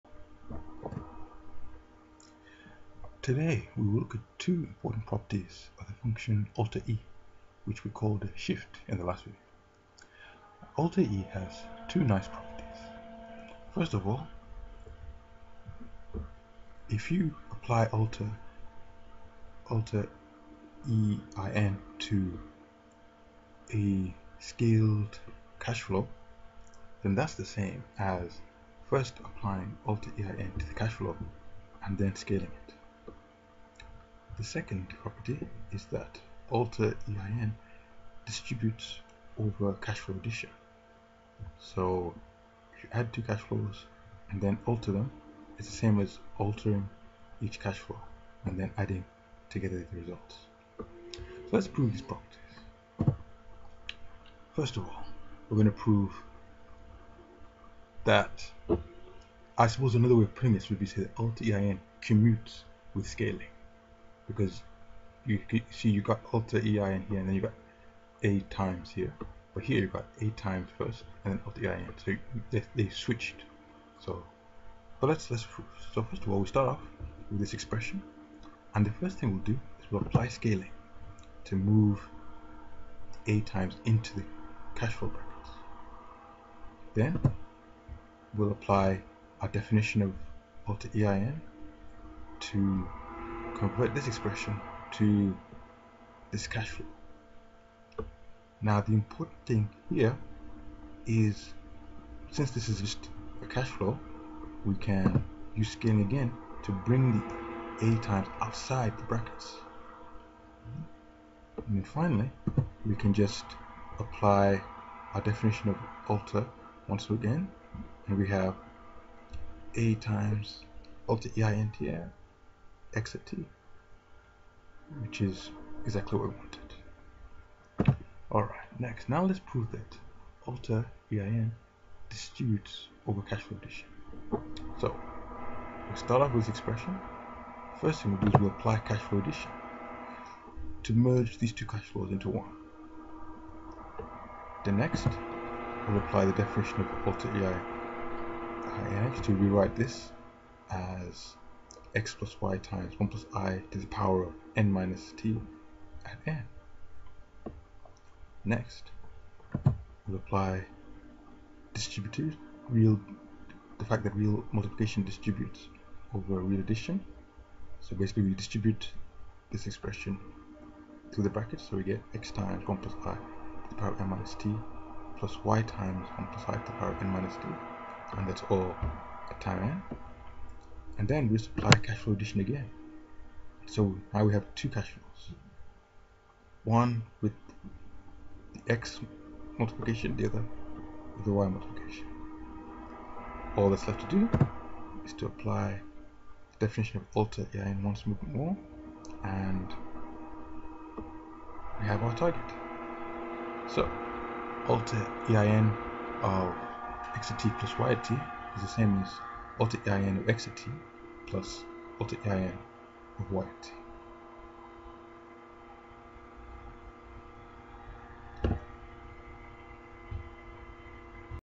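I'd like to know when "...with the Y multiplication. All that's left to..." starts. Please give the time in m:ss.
3:11.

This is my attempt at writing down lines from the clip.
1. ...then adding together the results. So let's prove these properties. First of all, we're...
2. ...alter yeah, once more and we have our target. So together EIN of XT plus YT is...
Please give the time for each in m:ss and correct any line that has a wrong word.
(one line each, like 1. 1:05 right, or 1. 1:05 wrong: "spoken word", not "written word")
1. 0:48 right
2. 3:17 wrong: "alter", not "together".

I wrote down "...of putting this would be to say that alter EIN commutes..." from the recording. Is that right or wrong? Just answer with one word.
right.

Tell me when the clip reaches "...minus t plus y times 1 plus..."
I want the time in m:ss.
2:54.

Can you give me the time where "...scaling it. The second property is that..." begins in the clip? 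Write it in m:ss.
0:32.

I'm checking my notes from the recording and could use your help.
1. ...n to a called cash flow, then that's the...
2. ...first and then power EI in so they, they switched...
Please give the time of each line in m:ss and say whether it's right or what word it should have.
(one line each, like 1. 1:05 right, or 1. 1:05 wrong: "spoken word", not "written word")
1. 0:21 wrong: "scaled", not "called"
2. 1:10 wrong: "alter", not "power".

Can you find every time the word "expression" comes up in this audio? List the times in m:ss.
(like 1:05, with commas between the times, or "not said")
1:17, 1:34, 2:16, 2:49.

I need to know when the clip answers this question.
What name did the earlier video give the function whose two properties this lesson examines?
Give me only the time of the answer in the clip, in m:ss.
0:08.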